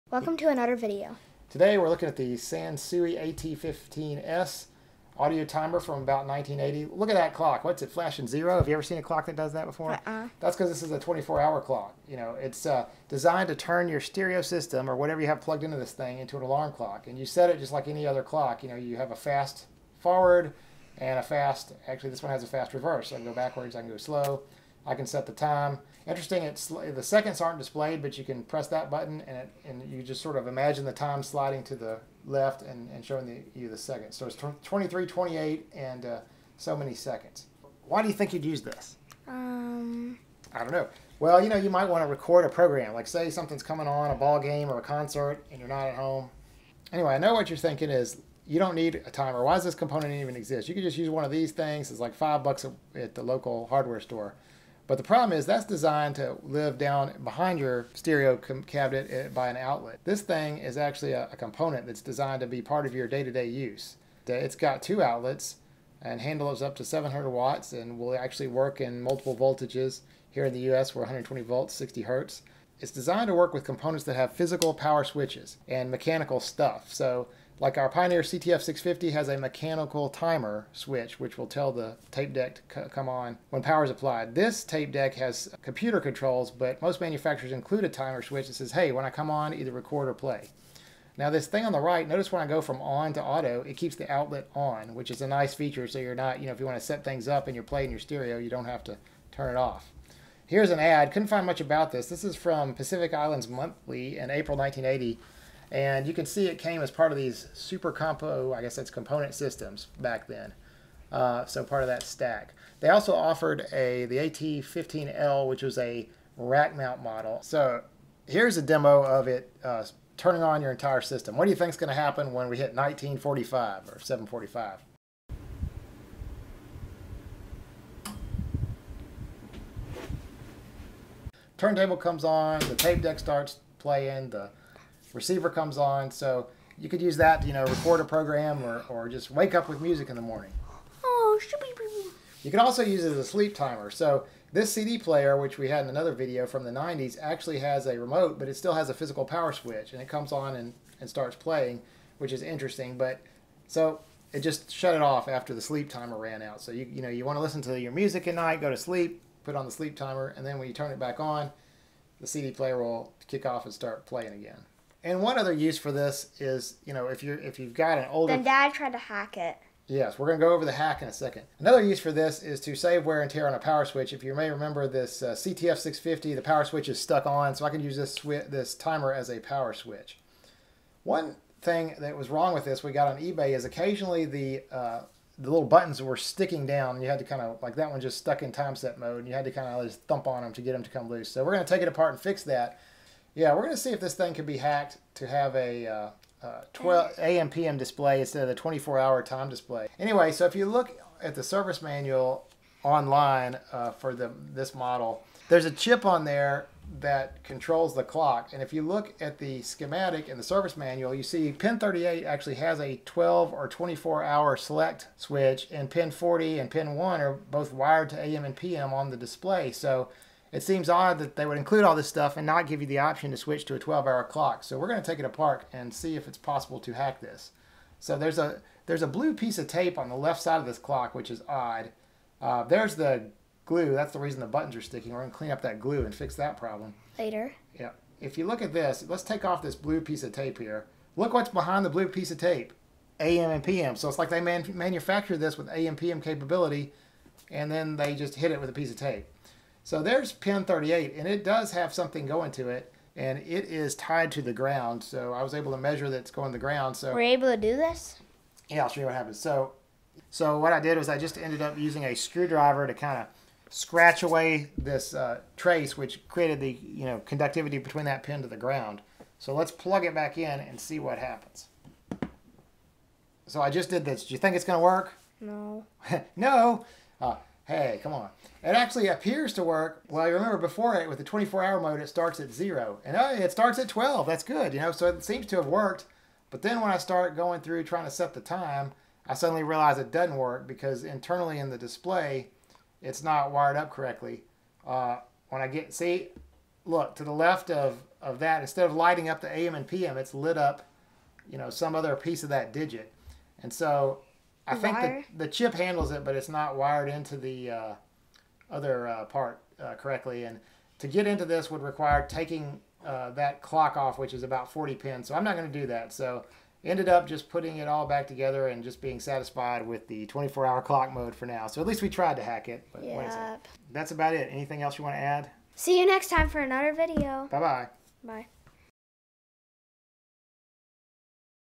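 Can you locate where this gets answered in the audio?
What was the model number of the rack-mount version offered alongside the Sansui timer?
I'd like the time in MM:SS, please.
01:54.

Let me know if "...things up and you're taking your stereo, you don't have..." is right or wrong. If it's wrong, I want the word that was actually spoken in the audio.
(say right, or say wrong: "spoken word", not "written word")
wrong: "playing", not "taking".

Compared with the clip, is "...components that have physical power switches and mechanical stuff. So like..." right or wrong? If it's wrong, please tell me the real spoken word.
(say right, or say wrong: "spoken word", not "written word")
right.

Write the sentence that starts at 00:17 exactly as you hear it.
And you set it just like any other clock.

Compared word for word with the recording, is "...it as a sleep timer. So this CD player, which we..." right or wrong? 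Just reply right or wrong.
right.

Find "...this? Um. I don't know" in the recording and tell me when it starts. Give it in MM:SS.
00:38.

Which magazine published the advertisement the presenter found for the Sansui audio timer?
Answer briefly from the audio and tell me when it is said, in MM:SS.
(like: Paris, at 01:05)
Pacific Islands Monthly, at 01:42.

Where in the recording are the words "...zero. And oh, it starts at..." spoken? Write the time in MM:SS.
04:42.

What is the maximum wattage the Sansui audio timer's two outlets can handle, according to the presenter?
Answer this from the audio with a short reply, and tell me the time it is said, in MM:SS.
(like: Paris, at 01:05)
700 watts, at 01:06.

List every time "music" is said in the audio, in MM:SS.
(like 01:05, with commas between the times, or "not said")
02:19, 02:37.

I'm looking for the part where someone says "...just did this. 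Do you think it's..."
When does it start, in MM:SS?
04:33.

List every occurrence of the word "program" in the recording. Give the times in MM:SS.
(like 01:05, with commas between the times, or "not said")
00:42, 02:18.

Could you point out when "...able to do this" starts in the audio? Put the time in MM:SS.
04:17.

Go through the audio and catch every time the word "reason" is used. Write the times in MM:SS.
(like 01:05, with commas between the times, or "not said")
03:54.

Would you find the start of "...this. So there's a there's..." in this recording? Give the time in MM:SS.
03:47.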